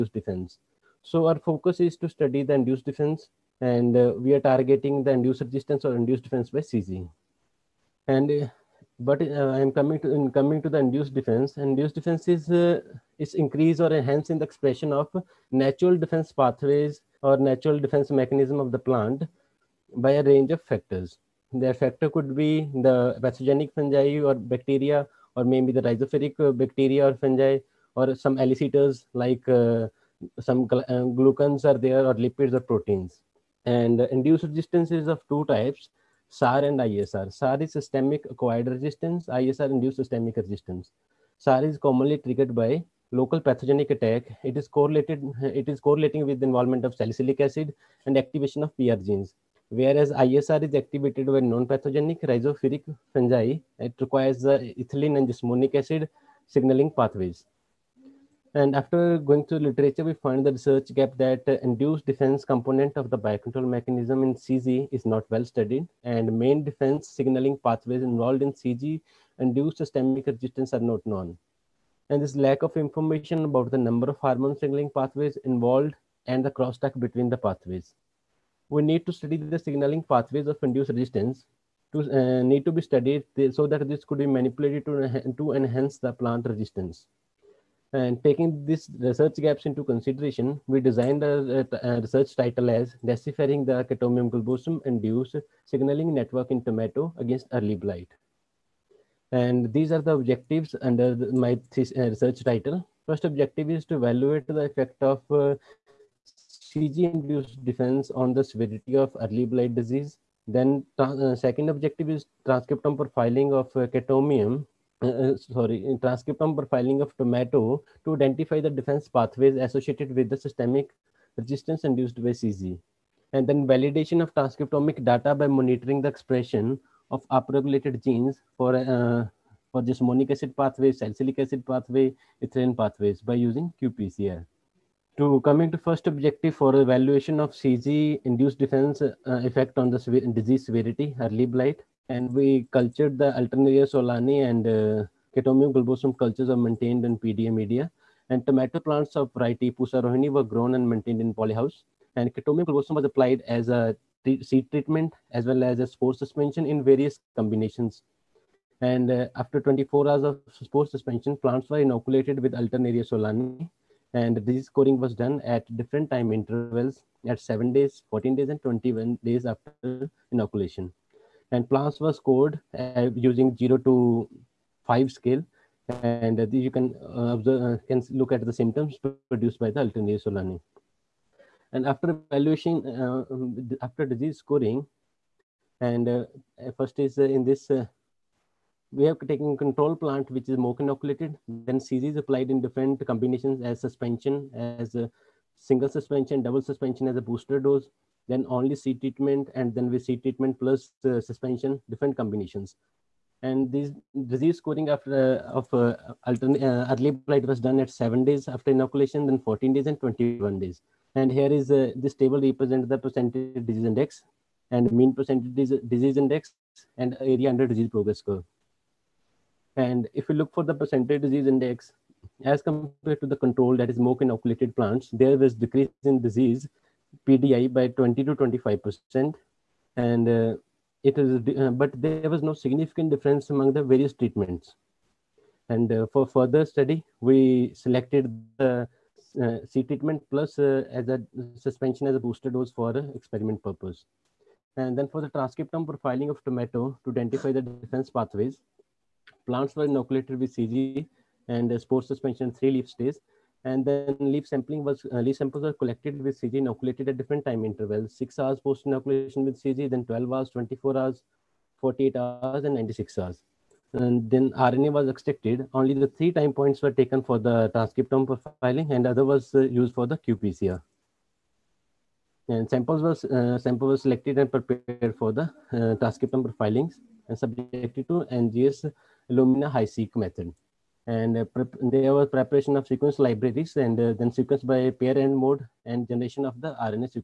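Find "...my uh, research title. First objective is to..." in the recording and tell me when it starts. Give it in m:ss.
1:41.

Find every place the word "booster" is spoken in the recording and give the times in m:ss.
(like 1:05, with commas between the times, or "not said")
3:17, 4:02.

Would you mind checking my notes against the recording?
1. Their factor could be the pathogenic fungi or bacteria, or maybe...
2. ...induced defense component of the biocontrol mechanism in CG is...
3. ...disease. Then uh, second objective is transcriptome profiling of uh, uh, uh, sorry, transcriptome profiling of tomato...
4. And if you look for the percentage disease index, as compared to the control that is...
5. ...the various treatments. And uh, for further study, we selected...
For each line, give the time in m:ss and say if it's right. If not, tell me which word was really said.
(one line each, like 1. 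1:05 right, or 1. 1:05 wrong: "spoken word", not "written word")
1. 0:21 right
2. 1:01 right
3. 1:49 right
4. 3:39 right
5. 3:53 right.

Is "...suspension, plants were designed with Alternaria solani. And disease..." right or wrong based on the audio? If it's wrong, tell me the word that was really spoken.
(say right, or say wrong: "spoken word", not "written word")
wrong: "inoculated", not "designed".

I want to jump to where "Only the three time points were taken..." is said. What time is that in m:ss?
4:25.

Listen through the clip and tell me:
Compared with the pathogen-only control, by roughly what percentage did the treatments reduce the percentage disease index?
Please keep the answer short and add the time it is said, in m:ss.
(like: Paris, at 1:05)
20 to 25 percent, at 3:47.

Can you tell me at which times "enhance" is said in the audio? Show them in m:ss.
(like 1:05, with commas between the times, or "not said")
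0:13, 1:25.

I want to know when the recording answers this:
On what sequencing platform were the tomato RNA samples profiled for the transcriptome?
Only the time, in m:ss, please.
4:38.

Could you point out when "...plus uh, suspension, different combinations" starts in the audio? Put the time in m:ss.
3:20.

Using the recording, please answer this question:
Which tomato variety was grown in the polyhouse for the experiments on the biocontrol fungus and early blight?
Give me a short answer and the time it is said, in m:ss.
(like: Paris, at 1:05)
Pusa Rohini, at 2:29.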